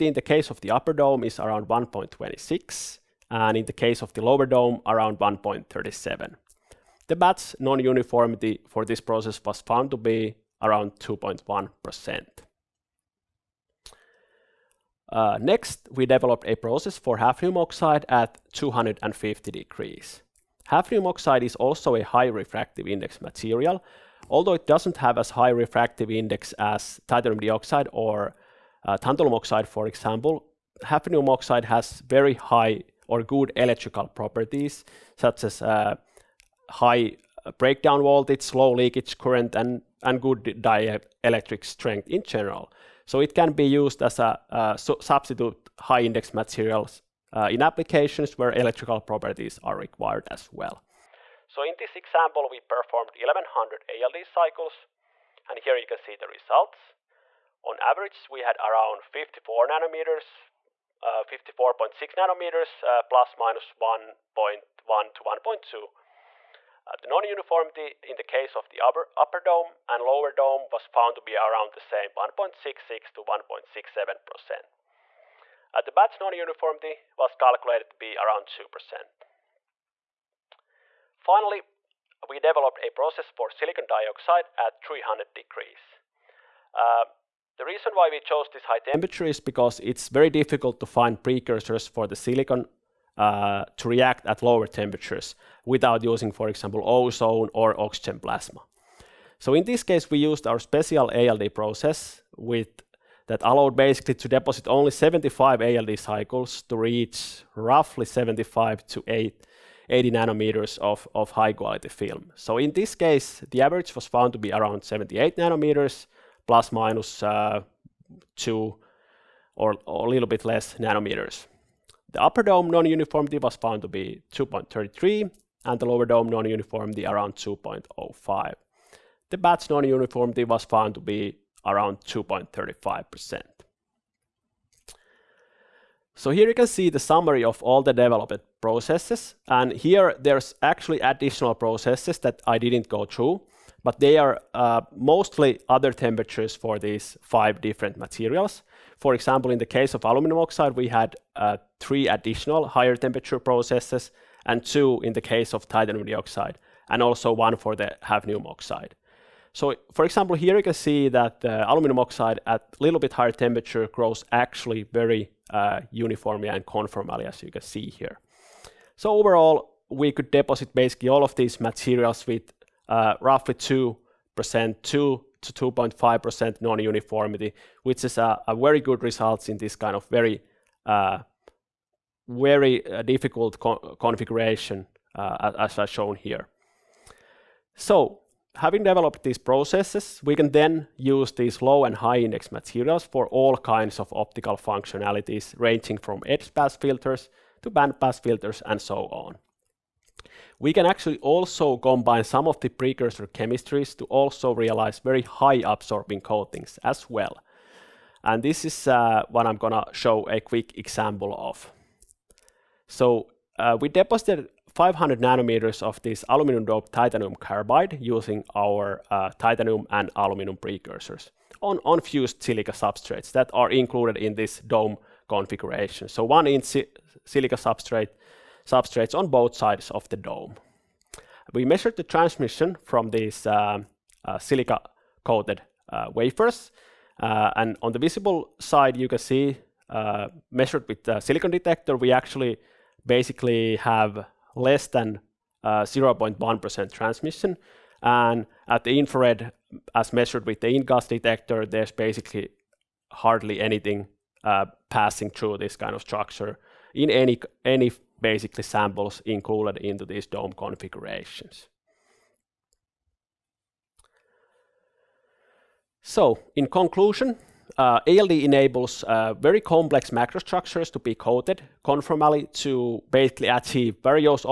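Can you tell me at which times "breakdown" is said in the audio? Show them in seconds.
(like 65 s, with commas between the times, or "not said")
37 s.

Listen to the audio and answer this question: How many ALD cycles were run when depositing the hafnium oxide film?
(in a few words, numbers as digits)
1100.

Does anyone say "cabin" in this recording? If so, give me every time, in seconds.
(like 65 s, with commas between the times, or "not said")
not said.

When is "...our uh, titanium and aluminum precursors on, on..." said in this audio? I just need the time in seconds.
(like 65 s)
218 s.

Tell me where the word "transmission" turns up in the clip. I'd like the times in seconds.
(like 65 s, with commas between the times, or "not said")
232 s, 246 s.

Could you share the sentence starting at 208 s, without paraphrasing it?
And this is uh, what I'm gonna show a quick example of.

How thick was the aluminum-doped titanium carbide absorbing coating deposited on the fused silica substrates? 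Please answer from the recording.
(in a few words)
500 nanometers.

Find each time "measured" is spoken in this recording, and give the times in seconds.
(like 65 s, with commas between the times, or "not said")
231 s, 240 s, 250 s.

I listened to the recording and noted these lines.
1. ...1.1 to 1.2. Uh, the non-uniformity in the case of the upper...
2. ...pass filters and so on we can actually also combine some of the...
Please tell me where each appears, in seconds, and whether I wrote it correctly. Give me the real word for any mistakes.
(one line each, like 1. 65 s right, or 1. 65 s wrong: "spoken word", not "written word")
1. 63 s right
2. 197 s right.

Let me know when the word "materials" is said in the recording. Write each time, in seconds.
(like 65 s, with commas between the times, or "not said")
23 s, 46 s, 147 s, 171 s, 192 s.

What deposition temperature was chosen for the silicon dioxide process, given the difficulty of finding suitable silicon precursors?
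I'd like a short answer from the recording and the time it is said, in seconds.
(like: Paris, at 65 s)
300 degrees, at 84 s.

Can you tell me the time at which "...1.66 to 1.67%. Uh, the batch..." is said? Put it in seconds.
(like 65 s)
72 s.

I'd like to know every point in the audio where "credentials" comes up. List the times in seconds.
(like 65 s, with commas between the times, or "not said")
not said.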